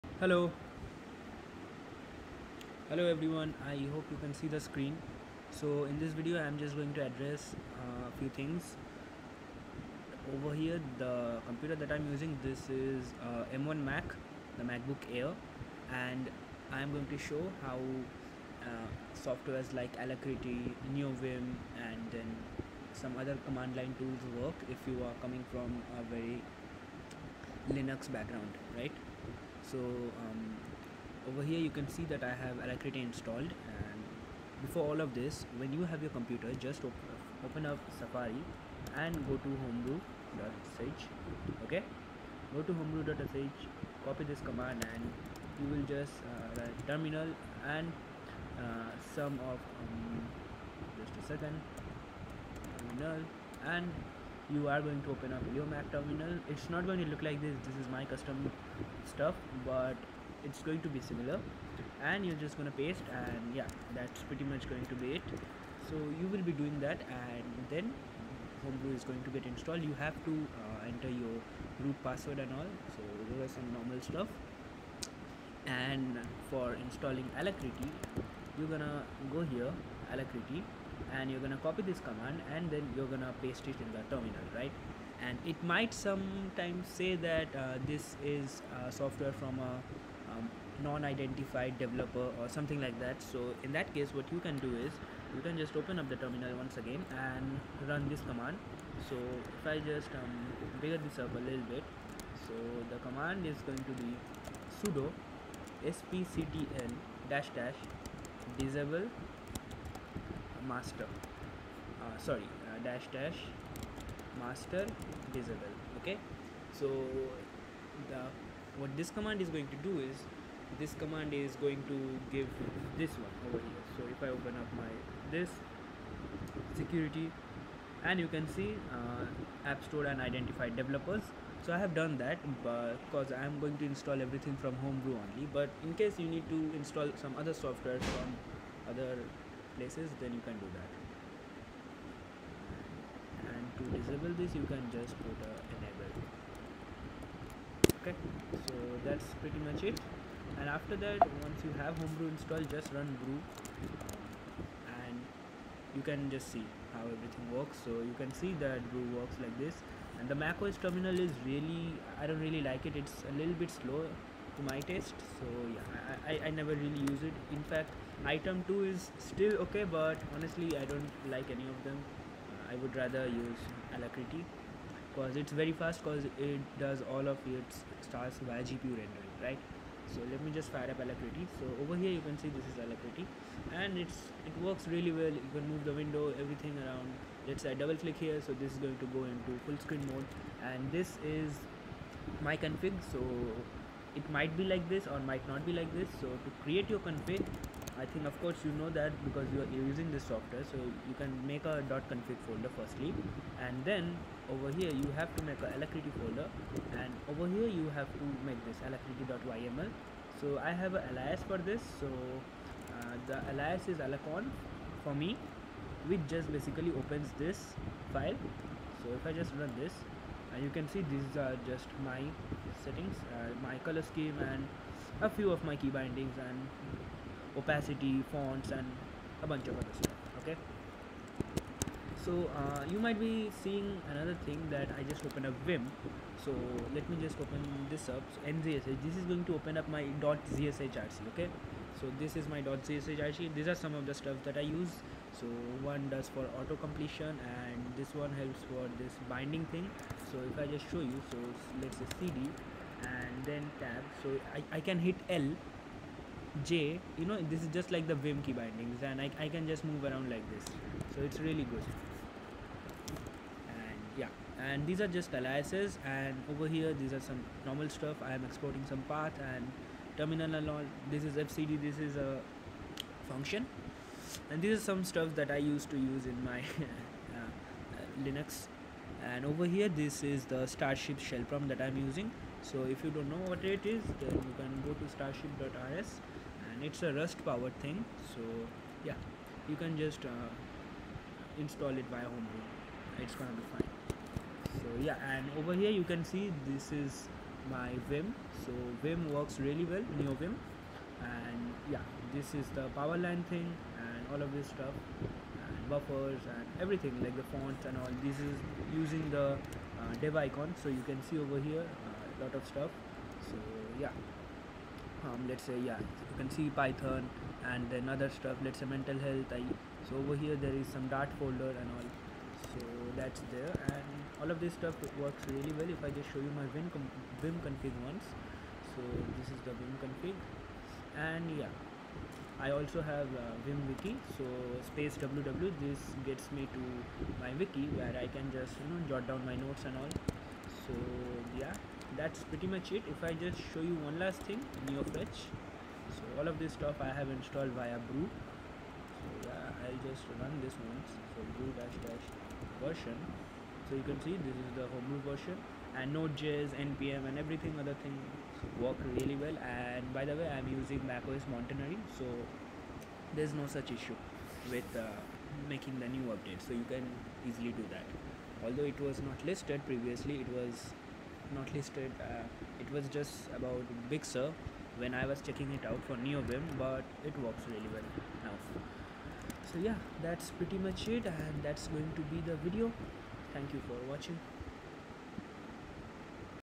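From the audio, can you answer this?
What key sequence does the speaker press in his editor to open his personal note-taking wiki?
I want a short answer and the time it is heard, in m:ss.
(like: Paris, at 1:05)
space www, at 5:34.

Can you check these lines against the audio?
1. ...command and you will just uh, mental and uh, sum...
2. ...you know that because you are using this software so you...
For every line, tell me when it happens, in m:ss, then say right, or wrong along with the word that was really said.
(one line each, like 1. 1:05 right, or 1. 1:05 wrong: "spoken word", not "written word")
1. 0:44 wrong: "terminal", not "mental"
2. 3:18 right.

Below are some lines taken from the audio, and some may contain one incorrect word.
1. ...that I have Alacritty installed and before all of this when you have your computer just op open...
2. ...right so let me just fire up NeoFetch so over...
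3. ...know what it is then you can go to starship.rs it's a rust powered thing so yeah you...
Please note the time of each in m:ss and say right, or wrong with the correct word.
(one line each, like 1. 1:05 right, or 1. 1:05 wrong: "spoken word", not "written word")
1. 0:32 right
2. 2:59 wrong: "Alacritty", not "NeoFetch"
3. 4:43 right.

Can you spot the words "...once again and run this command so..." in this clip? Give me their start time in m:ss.
1:36.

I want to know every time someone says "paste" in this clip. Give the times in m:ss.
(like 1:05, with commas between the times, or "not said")
1:02, 1:23.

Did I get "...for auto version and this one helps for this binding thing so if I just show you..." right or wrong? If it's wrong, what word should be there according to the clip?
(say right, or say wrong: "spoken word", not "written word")
wrong: "completion", not "version".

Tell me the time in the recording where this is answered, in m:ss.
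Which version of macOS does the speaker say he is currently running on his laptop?
6:01.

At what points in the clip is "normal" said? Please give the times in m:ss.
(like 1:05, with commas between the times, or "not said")
1:13, 4:27.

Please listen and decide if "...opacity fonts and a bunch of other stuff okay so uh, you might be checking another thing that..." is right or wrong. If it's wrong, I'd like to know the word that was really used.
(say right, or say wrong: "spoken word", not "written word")
wrong: "seeing", not "checking".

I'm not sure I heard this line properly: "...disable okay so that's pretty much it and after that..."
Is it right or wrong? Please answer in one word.
wrong.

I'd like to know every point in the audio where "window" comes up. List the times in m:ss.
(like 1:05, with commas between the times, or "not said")
3:05.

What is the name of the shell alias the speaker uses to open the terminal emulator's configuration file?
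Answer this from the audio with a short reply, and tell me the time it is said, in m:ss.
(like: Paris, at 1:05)
alacon, at 3:33.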